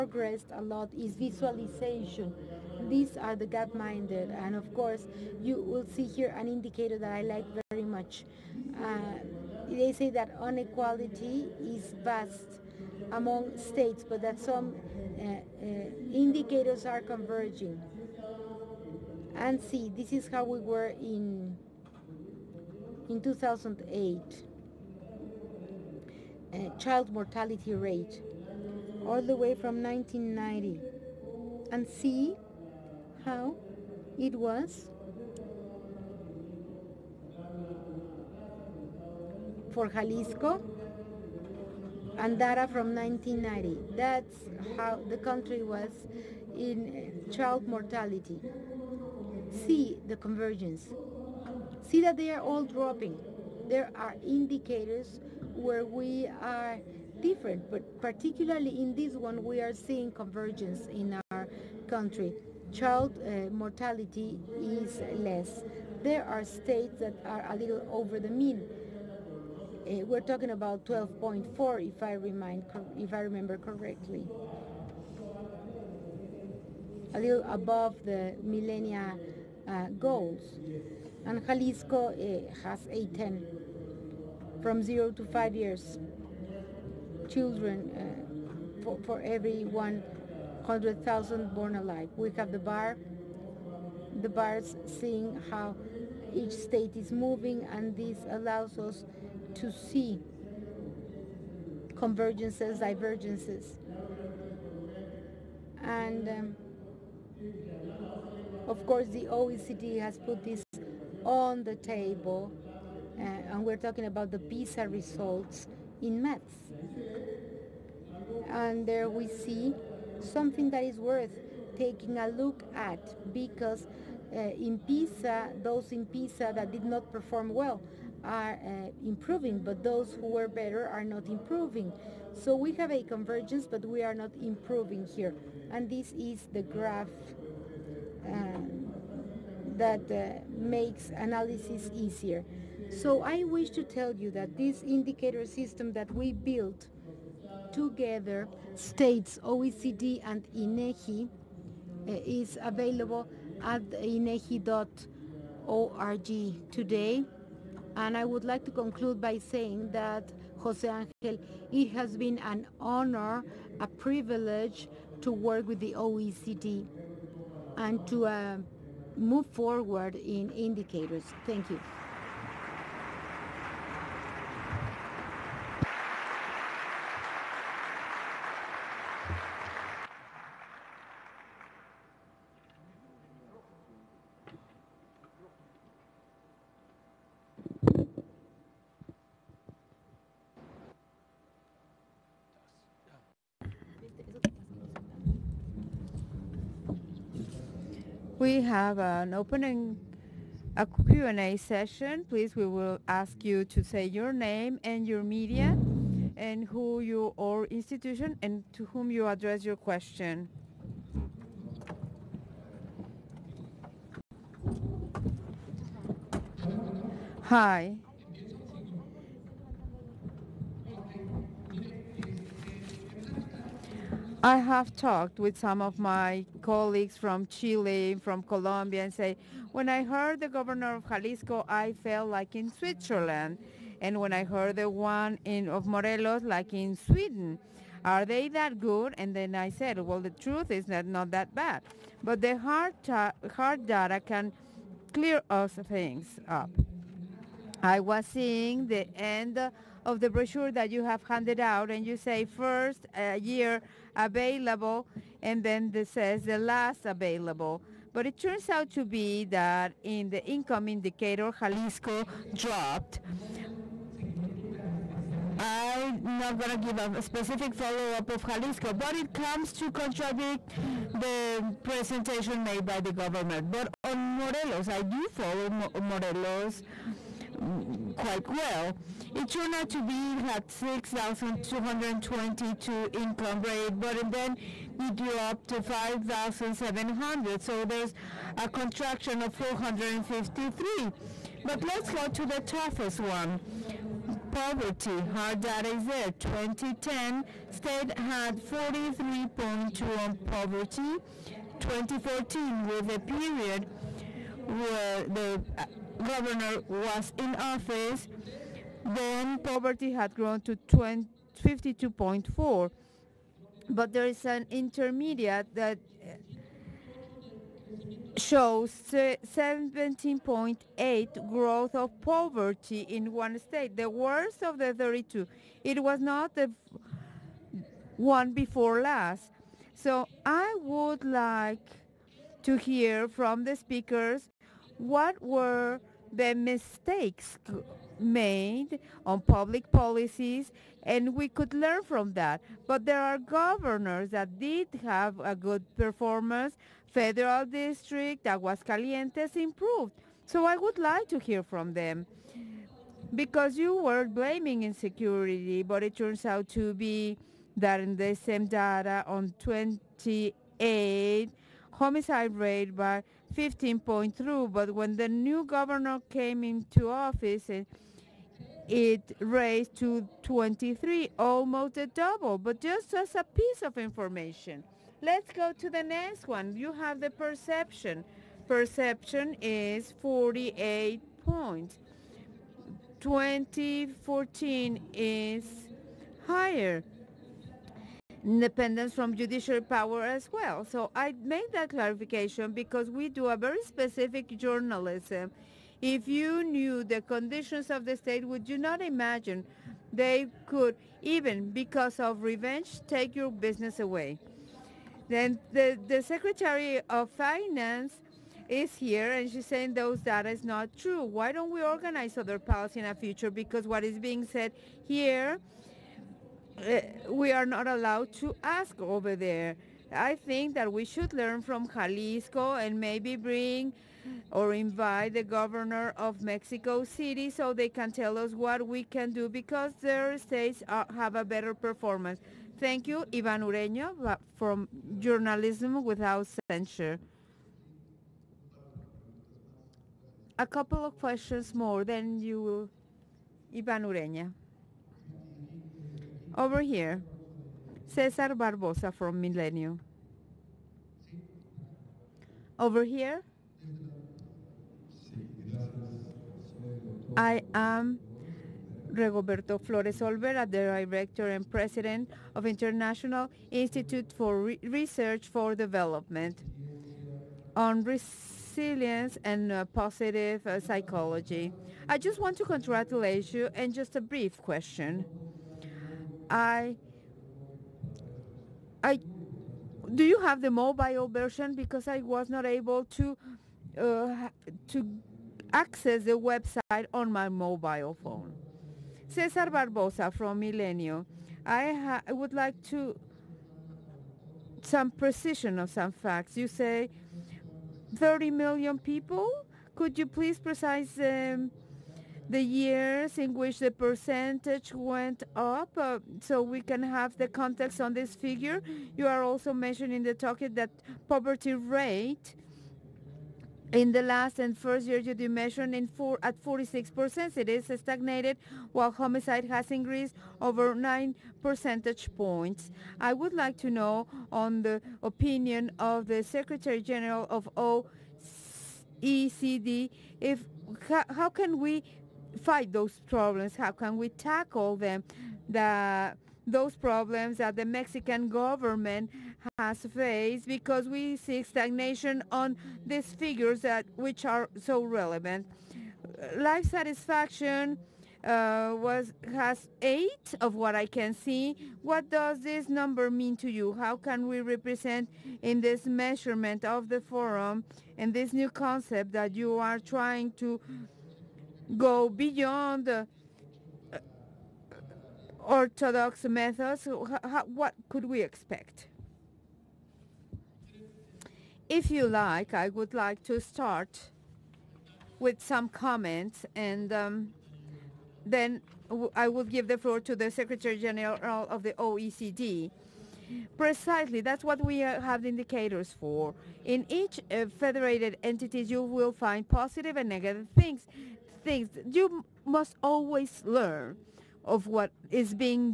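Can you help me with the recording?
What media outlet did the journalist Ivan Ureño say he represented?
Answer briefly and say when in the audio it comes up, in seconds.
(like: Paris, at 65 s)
Journalism Without Censure, at 435 s.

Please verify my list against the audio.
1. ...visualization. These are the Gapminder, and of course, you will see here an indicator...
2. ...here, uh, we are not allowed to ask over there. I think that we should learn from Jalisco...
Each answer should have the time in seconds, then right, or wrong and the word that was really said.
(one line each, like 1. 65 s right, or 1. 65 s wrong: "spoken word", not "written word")
1. 1 s right
2. 415 s right.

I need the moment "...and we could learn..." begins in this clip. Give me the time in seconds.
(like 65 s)
341 s.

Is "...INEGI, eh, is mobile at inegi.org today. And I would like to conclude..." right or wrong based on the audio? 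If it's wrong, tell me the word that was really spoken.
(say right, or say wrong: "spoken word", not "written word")
wrong: "available", not "mobile".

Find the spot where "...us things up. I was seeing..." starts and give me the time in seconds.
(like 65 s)
245 s.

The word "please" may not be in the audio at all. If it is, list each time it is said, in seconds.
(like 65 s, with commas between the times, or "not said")
202 s, 500 s.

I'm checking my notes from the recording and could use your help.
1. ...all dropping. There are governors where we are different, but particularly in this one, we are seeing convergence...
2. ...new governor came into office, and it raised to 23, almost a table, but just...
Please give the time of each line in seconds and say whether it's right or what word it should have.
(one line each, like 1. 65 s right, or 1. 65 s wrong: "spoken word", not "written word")
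1. 52 s wrong: "indicators", not "governors"
2. 365 s wrong: "double", not "table".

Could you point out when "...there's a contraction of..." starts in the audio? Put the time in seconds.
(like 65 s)
287 s.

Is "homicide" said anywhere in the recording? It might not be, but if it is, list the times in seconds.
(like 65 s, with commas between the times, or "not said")
361 s, 519 s.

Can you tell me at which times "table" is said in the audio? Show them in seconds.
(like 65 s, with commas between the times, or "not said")
111 s.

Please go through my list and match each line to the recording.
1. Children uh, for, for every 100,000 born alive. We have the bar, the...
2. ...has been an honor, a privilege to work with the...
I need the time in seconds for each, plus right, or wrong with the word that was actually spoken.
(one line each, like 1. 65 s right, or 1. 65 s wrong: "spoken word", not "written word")
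1. 87 s right
2. 161 s right.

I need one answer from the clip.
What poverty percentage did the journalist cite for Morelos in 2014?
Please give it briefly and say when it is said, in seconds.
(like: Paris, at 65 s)
52.4, at 310 s.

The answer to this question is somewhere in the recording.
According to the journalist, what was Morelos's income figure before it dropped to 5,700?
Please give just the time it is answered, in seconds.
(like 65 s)
280 s.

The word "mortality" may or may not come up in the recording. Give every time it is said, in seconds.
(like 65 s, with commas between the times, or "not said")
27 s, 47 s, 63 s.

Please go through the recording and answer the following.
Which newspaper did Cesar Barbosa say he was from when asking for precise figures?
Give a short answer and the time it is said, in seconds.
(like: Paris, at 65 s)
Milenio, at 490 s.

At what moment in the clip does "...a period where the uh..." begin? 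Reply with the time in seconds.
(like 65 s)
303 s.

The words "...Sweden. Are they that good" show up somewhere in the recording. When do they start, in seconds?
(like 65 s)
236 s.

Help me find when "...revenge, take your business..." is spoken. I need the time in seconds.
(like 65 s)
402 s.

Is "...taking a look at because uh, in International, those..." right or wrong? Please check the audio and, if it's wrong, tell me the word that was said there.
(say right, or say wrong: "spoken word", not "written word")
wrong: "PISA", not "International".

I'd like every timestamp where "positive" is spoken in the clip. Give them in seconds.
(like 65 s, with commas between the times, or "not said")
469 s, 589 s.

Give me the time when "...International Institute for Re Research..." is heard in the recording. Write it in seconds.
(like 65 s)
462 s.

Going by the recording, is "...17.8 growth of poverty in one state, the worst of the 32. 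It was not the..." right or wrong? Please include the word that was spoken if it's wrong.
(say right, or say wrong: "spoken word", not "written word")
right.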